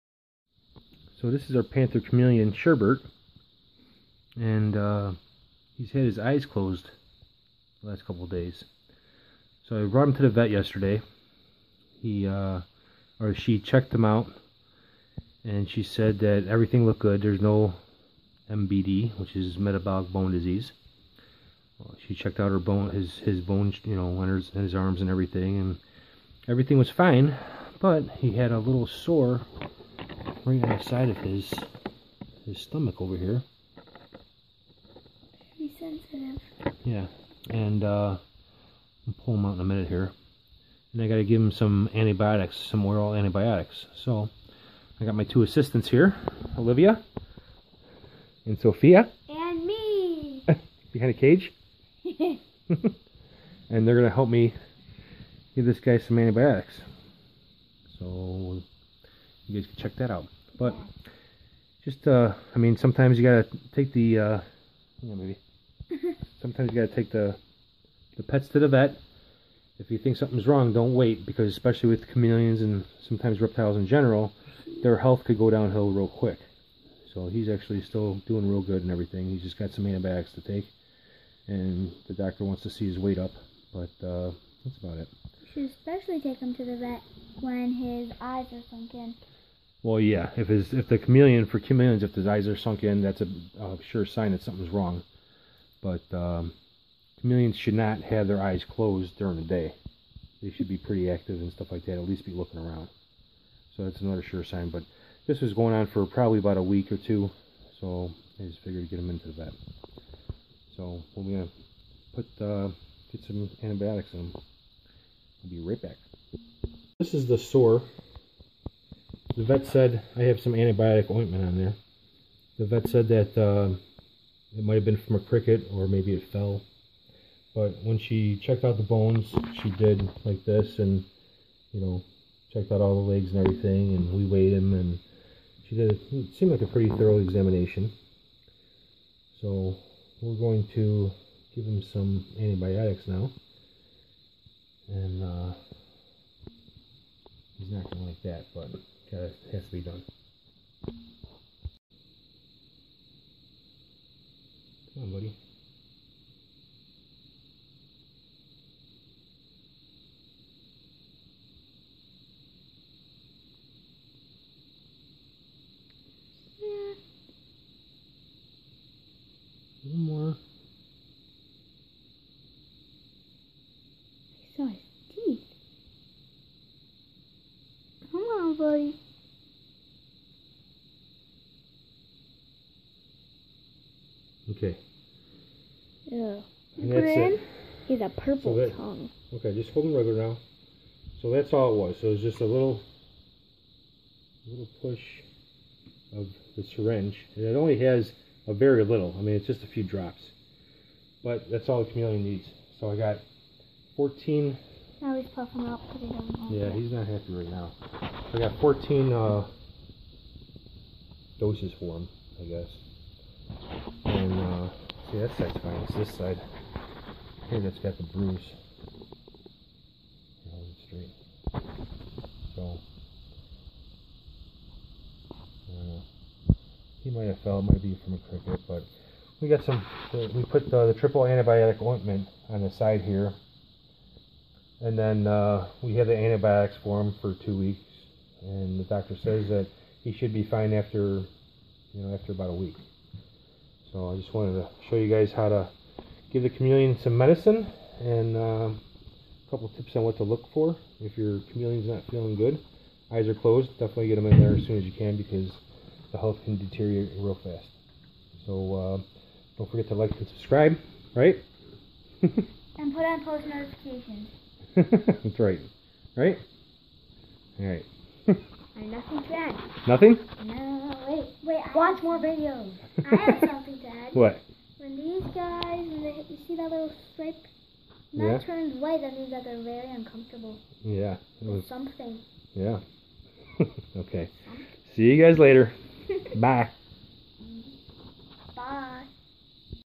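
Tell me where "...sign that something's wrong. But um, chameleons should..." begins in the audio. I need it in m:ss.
1:34.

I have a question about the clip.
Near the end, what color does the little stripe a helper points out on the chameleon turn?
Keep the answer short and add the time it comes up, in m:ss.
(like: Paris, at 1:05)
White, at 4:38.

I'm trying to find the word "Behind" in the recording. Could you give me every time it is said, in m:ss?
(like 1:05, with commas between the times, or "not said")
0:50.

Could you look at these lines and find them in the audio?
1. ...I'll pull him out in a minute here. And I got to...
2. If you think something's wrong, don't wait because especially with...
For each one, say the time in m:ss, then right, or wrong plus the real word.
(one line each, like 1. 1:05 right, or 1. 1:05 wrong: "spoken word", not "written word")
1. 0:39 right
2. 1:09 right.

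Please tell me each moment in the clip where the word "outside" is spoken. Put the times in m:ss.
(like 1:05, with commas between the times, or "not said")
0:30.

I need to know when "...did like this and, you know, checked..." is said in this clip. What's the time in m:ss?
2:09.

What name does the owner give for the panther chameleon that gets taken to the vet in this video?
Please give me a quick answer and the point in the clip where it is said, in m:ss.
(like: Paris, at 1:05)
Sherbert, at 0:02.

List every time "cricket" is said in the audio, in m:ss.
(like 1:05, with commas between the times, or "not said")
2:05, 3:48.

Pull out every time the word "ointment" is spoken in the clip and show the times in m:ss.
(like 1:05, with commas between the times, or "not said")
2:01, 3:51.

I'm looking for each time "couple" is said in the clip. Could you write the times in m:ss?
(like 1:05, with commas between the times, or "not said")
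0:08, 4:09.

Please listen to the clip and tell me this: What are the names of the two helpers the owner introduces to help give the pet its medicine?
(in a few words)
Olivia and Sophia.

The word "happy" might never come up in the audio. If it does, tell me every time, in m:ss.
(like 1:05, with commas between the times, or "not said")
3:27.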